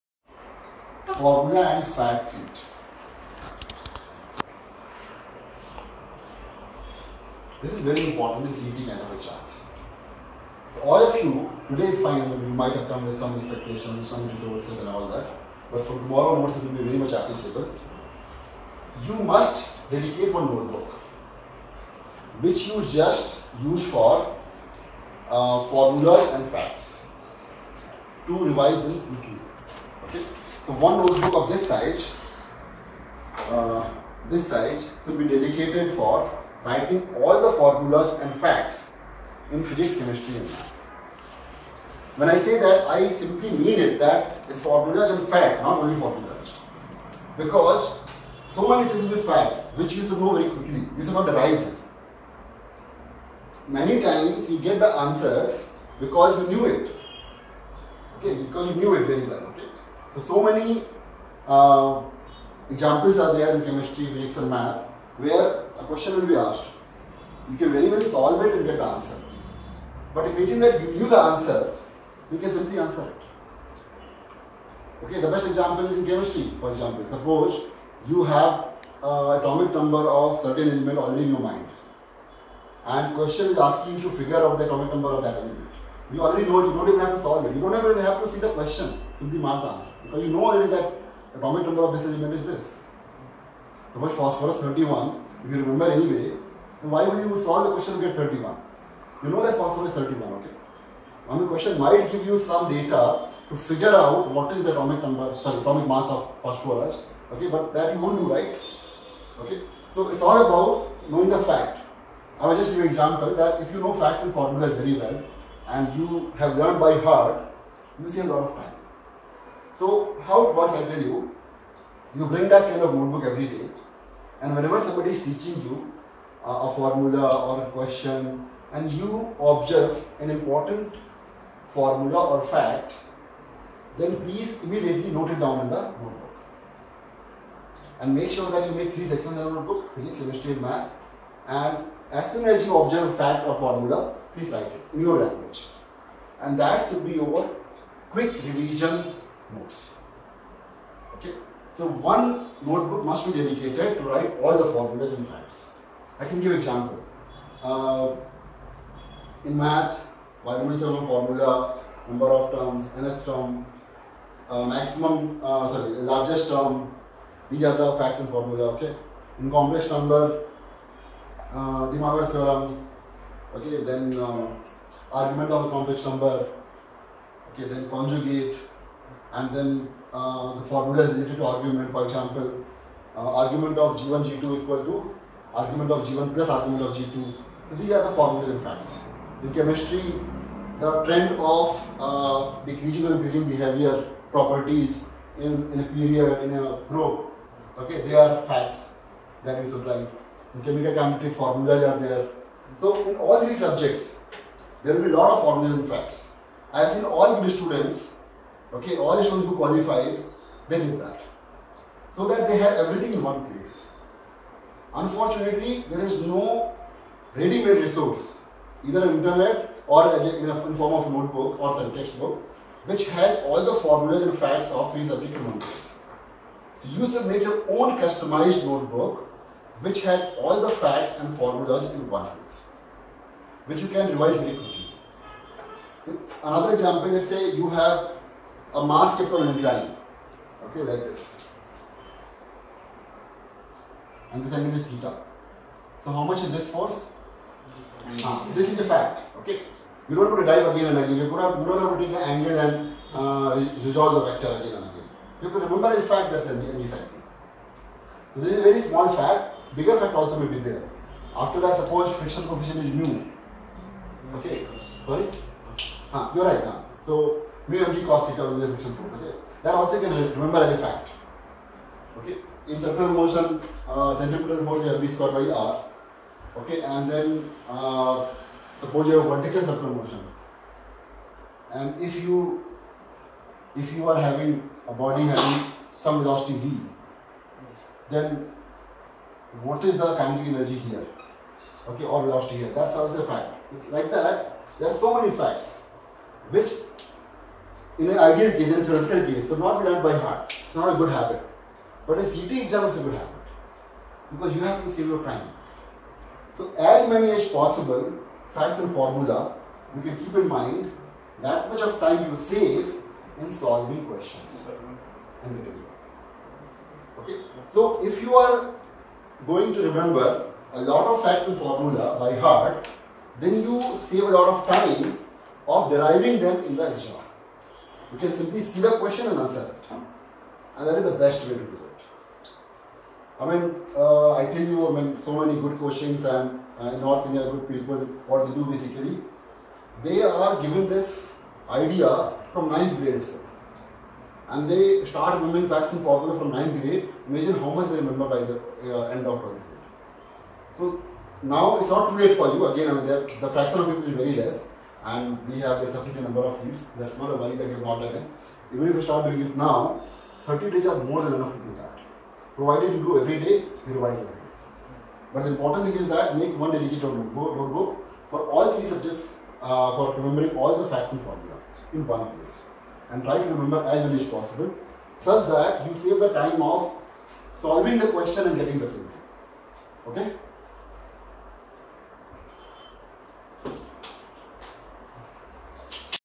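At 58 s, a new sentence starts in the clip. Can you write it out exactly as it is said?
Okay, because you knew it very well.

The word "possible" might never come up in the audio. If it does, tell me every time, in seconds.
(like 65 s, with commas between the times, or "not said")
307 s, 374 s.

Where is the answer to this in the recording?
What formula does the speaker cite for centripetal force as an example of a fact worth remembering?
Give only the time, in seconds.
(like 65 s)
275 s.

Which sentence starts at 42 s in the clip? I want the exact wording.
When I say that, I simply mean it that it's formulas and facts, not only formulas.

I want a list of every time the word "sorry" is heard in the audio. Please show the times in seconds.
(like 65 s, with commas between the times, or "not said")
105 s, 165 s, 265 s.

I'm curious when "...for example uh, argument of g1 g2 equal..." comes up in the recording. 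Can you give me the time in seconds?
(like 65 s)
181 s.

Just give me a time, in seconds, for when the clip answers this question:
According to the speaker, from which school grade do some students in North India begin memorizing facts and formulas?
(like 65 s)
346 s.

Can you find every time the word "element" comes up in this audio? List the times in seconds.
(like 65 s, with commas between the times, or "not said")
80 s, 85 s, 92 s.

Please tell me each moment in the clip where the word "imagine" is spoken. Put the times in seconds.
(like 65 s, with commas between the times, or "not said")
70 s, 347 s.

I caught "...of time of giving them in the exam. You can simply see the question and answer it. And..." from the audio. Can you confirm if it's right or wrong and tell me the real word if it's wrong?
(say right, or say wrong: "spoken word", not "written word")
wrong: "deriving", not "giving".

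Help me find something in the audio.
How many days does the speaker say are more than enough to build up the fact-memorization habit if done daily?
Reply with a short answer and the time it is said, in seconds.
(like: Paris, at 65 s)
30, at 360 s.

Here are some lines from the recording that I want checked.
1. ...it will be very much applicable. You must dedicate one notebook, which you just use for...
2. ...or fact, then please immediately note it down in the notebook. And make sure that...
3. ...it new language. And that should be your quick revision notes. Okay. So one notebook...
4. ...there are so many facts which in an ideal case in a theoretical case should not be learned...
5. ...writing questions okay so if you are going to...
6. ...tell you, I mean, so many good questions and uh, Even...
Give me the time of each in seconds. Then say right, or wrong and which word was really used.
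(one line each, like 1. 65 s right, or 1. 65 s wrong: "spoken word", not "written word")
1. 16 s right
2. 132 s right
3. 144 s right
4. 294 s right
5. 313 s wrong: "solving", not "writing"
6. 334 s wrong: "North", not "Even".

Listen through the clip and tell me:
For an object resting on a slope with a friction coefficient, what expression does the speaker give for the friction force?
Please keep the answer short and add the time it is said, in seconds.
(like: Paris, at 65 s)
mu mg cos theta, at 267 s.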